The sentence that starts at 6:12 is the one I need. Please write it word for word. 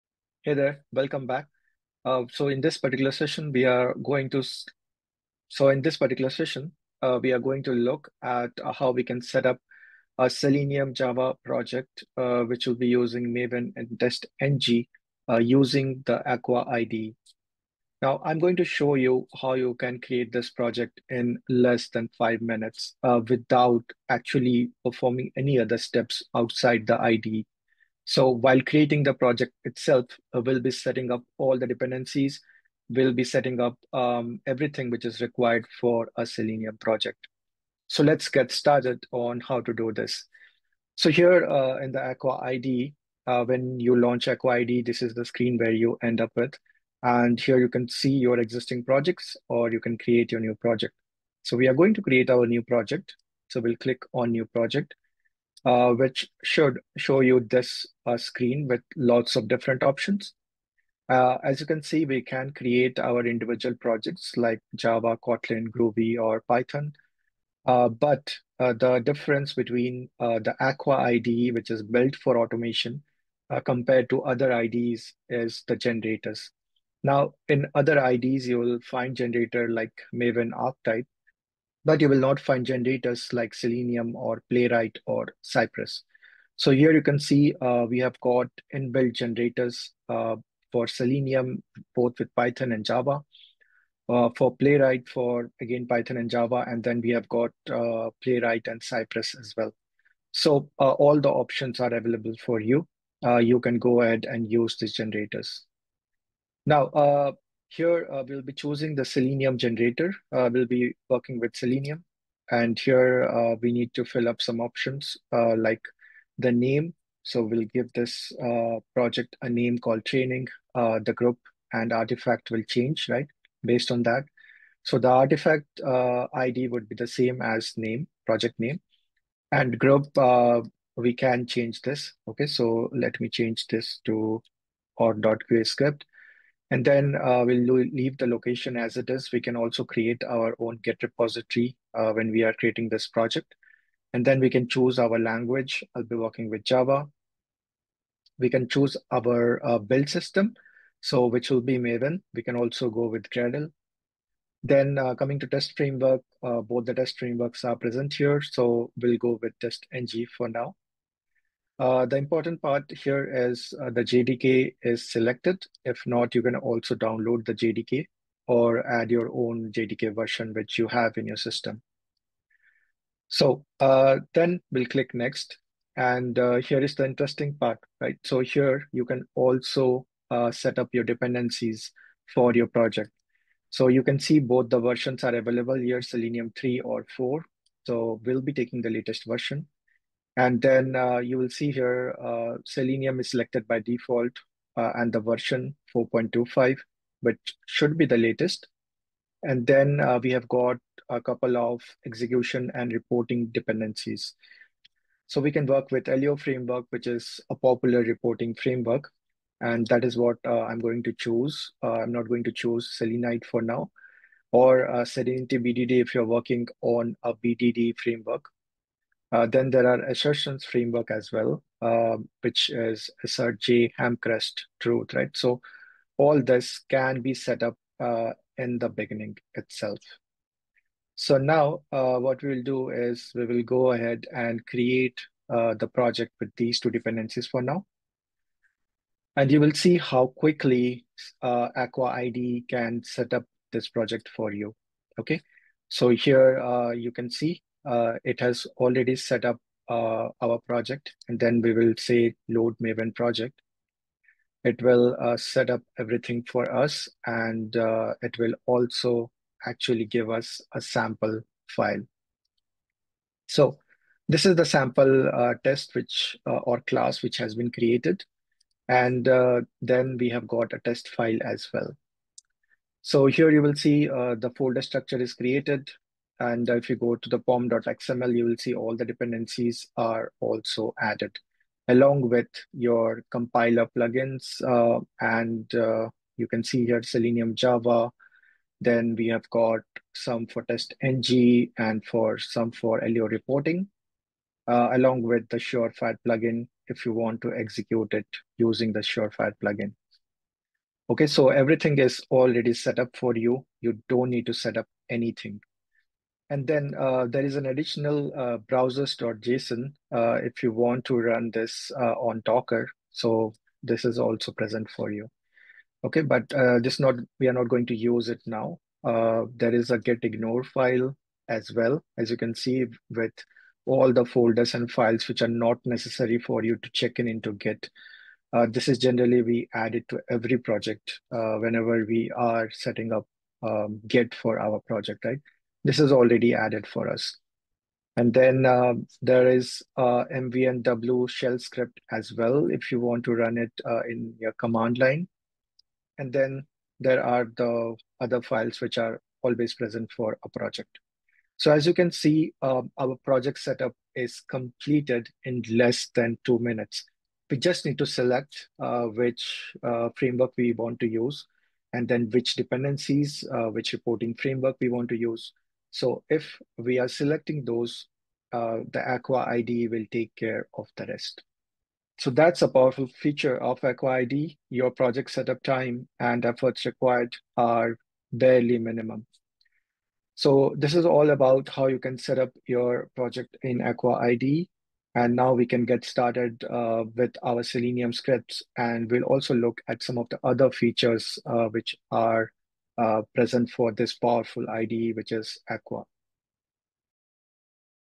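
So that's a powerful feature of Aqua ID.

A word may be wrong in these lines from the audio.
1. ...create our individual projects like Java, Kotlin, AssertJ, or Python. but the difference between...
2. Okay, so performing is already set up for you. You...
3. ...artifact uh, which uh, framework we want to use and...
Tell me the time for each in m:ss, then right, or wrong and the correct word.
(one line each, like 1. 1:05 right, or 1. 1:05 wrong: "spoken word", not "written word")
1. 1:02 wrong: "Groovy", not "AssertJ"
2. 5:01 wrong: "everything", not "performing"
3. 5:58 wrong: "select", not "artifact".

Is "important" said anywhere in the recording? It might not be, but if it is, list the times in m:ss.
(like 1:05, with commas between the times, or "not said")
2:42.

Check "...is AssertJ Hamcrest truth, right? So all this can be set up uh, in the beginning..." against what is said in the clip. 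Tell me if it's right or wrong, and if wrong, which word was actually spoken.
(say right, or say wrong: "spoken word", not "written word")
right.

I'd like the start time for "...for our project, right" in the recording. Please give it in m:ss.
5:34.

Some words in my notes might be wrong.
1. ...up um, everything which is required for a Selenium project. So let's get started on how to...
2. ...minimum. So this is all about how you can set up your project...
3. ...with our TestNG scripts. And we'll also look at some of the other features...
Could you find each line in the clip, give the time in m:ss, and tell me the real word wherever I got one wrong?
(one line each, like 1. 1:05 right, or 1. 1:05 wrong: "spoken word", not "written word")
1. 0:33 right
2. 6:18 right
3. 6:27 wrong: "Selenium", not "TestNG".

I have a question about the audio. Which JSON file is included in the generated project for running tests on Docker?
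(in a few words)
browsers.json.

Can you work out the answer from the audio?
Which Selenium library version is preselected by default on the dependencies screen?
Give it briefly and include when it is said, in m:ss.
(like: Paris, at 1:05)
4.25, at 3:15.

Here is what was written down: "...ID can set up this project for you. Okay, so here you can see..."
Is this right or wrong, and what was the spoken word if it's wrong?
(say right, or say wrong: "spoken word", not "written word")
right.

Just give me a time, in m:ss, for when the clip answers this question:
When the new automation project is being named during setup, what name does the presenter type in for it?
2:00.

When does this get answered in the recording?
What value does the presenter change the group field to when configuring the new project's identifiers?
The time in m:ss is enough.
2:14.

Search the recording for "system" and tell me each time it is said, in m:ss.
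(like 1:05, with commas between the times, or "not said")
2:30, 2:51.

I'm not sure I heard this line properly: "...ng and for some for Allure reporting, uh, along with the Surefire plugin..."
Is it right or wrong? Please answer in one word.
right.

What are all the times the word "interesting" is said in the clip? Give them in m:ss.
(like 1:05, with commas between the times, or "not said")
2:57.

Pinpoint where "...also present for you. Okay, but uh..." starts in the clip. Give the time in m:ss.
5:14.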